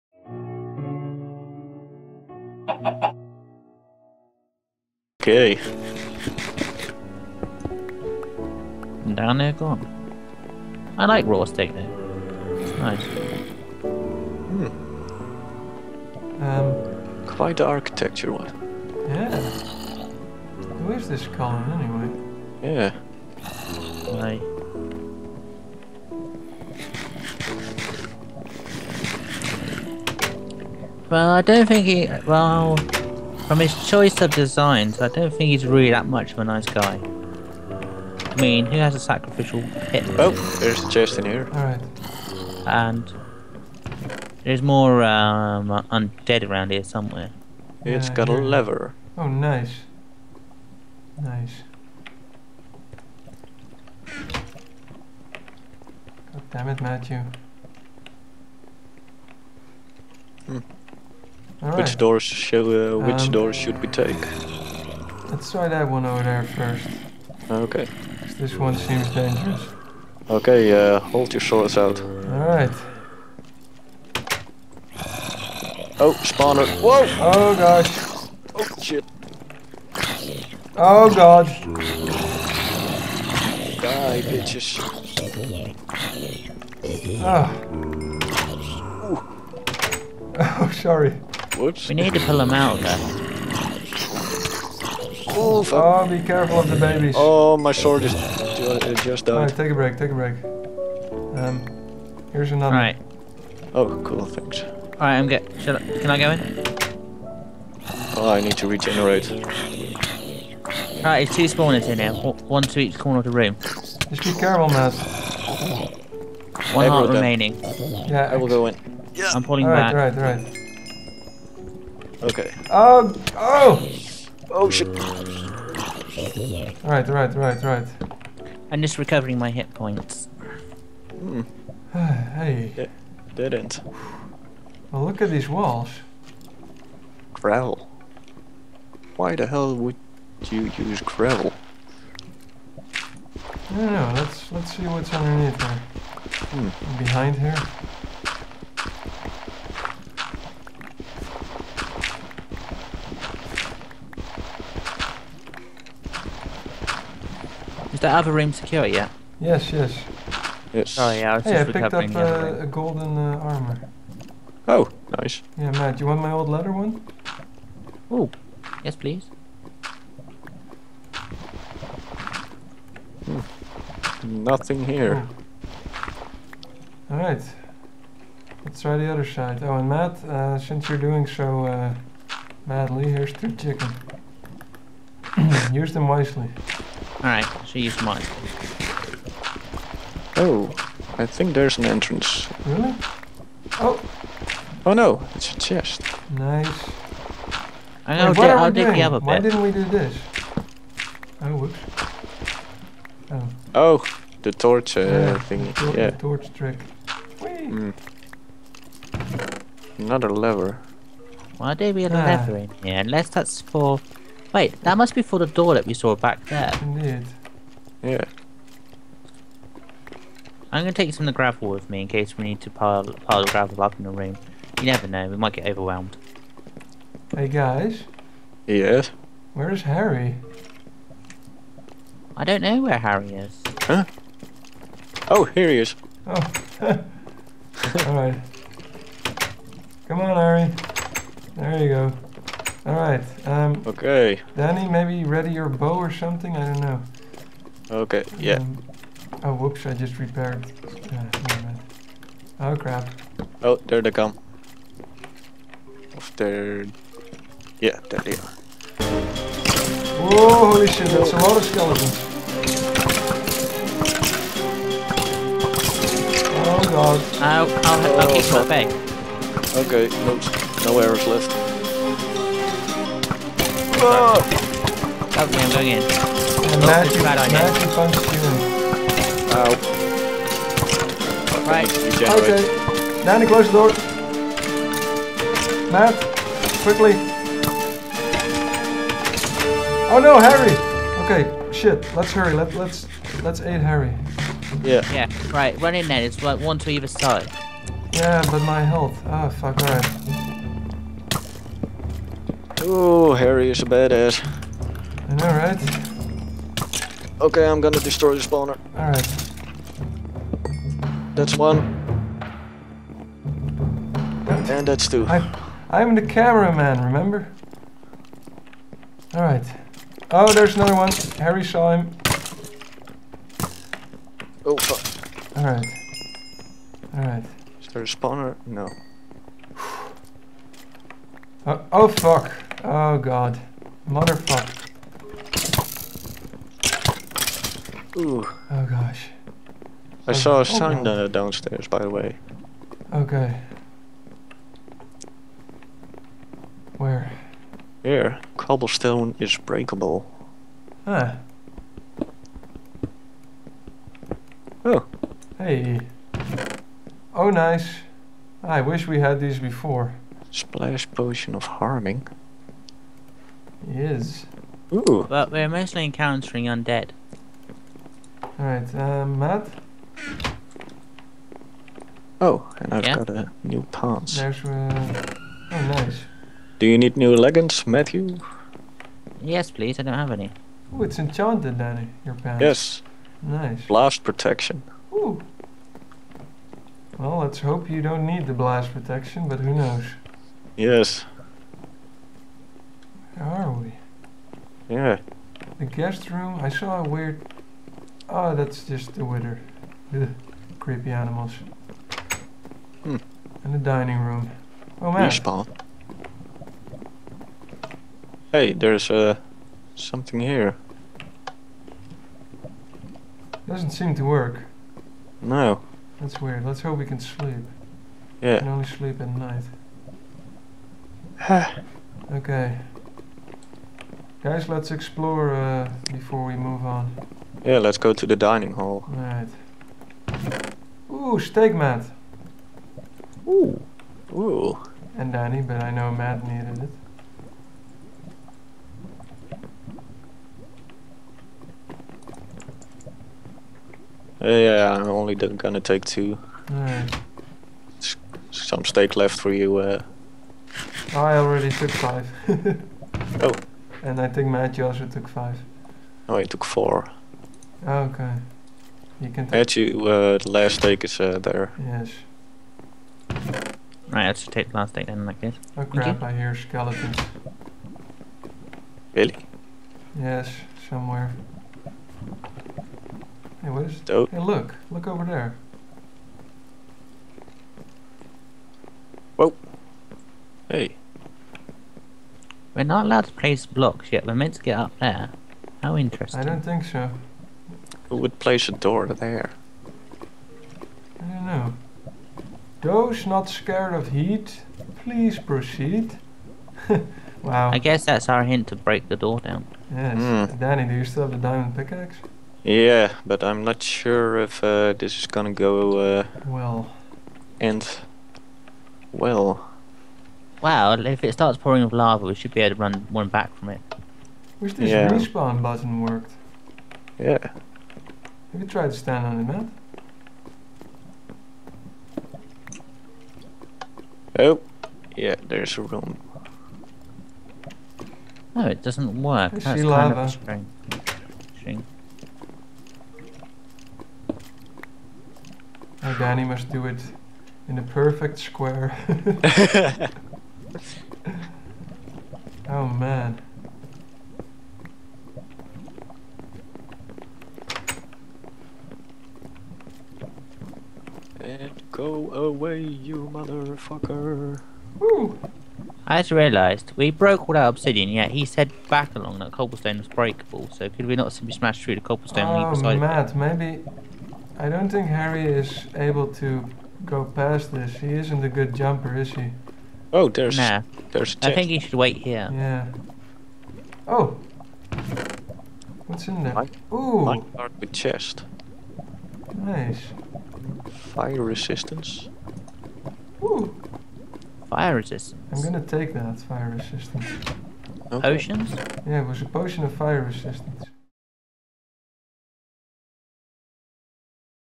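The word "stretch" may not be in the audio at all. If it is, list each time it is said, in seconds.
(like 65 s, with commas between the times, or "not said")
not said.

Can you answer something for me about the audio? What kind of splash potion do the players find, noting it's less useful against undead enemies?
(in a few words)
Harming.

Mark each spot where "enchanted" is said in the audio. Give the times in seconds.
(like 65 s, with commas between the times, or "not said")
381 s.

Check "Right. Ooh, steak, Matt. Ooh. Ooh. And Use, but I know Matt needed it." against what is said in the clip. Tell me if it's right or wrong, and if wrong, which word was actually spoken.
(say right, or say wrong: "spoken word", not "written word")
wrong: "Danny", not "Use".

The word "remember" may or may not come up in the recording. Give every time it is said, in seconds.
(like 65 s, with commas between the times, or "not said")
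317 s.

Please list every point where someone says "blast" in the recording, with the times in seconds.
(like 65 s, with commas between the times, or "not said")
383 s, 388 s.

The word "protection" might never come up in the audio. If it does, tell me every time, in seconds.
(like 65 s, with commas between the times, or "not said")
384 s, 388 s.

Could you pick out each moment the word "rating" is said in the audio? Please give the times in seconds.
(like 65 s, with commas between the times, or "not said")
not said.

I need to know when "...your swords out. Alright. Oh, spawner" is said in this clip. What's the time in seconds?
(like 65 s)
71 s.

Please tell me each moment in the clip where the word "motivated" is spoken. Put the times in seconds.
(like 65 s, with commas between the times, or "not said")
not said.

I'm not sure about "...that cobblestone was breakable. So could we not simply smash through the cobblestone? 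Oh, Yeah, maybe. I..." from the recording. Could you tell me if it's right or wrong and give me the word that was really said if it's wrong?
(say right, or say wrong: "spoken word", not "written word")
wrong: "Matt", not "Yeah".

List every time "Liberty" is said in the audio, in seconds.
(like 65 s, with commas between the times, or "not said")
not said.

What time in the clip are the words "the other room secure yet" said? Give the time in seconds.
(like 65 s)
158 s.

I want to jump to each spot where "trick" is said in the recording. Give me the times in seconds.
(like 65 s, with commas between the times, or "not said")
206 s.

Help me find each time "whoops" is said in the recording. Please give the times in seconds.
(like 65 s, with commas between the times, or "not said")
91 s, 201 s, 249 s.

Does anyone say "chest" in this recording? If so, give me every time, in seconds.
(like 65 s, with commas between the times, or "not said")
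40 s, 195 s, 577 s.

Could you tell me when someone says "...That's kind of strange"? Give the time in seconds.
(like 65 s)
529 s.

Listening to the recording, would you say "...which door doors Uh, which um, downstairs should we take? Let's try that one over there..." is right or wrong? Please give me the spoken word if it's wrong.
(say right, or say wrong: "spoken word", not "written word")
wrong: "doors", not "downstairs".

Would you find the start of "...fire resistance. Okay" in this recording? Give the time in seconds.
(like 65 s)
586 s.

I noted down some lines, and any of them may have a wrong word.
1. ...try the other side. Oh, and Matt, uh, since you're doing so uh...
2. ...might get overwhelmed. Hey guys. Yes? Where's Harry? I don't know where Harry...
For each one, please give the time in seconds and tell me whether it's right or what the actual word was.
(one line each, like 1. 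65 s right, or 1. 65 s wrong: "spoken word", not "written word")
1. 178 s right
2. 225 s right.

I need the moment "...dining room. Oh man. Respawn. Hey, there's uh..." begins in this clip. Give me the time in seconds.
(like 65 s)
403 s.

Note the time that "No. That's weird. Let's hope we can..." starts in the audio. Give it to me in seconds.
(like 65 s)
415 s.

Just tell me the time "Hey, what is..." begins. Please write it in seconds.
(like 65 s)
473 s.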